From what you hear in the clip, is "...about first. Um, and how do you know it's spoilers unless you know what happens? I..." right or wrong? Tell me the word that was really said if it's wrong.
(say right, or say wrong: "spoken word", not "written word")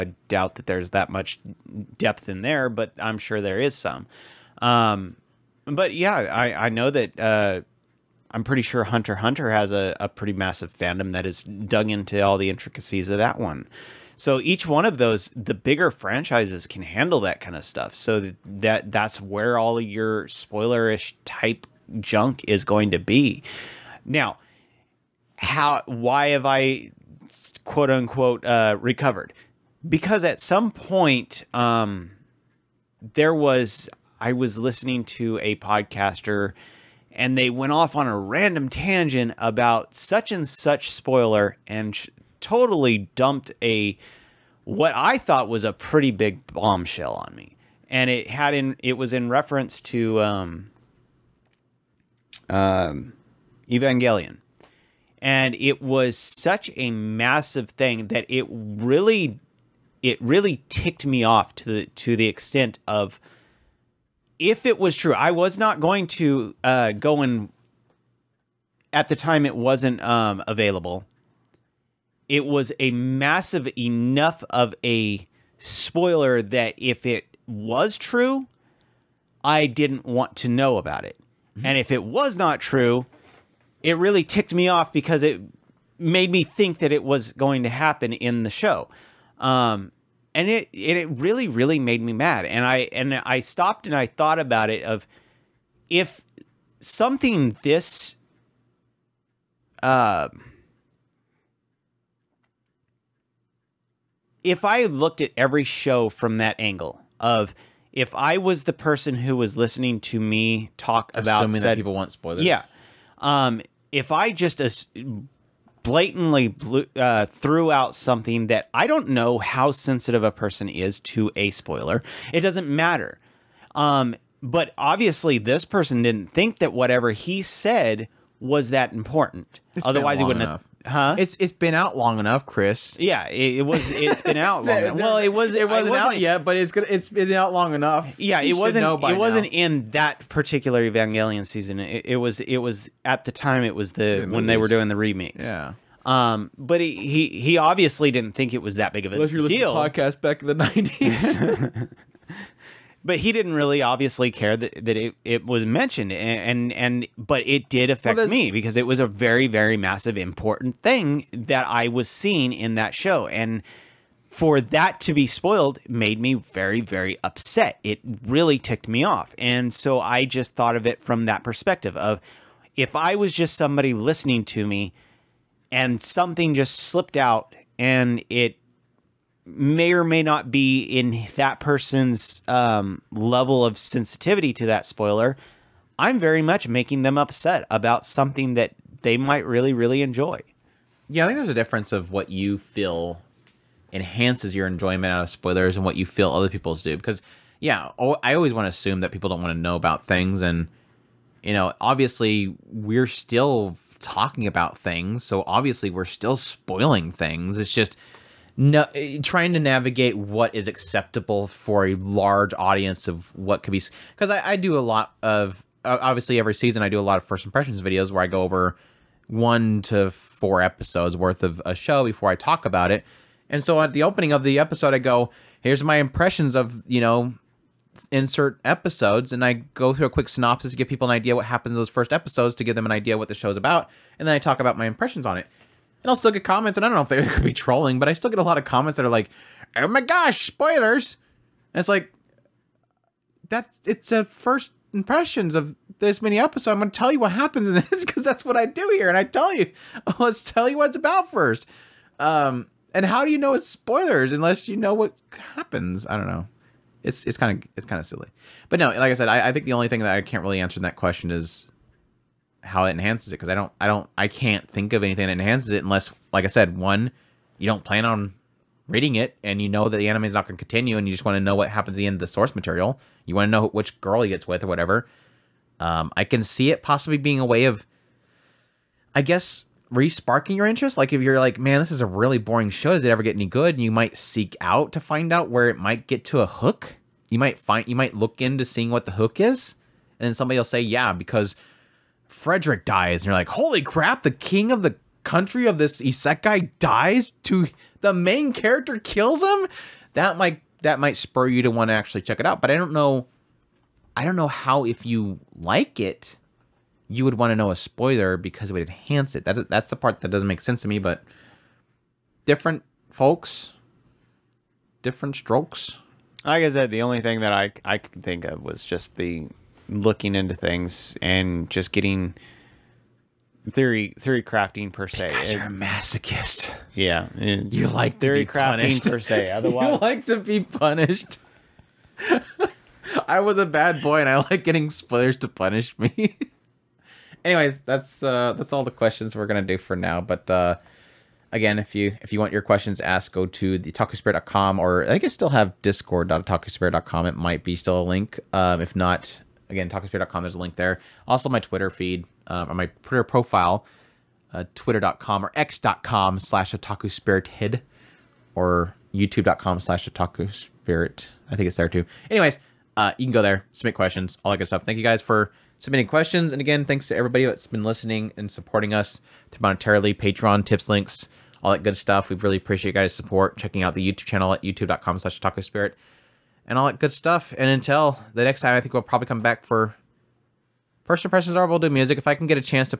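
right.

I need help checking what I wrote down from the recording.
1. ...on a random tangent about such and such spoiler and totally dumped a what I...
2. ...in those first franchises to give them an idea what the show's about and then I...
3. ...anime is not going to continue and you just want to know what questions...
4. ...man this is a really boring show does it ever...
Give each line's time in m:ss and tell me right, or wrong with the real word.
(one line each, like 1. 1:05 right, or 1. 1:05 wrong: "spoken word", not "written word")
1. 0:37 right
2. 3:51 wrong: "episodes", not "franchises"
3. 4:30 wrong: "happens", not "questions"
4. 4:41 right.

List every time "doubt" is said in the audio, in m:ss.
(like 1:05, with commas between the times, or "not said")
0:00.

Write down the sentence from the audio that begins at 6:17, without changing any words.
And until the next time, I think we'll probably come back for First Impressions Or We'll do music.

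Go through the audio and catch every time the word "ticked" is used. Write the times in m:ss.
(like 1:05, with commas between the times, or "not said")
1:00, 1:24, 2:48.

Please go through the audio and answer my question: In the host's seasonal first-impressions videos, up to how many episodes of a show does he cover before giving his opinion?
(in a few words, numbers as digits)
4.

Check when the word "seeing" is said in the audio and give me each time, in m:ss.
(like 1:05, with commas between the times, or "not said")
2:42, 4:48.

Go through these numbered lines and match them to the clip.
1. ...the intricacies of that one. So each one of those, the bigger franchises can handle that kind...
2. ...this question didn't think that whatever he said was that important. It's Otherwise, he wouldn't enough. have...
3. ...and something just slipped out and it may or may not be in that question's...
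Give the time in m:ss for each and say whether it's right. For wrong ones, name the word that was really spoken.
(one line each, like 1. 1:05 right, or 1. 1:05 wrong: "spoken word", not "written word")
1. 0:12 right
2. 2:05 wrong: "person", not "question"
3. 2:55 wrong: "person", not "question".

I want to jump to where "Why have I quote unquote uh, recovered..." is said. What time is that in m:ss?
0:25.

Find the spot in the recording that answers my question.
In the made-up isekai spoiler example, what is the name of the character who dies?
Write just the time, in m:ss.
4:52.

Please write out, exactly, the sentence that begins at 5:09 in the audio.
That, that's the part that doesn't make sense to me, but different folks, different strokes.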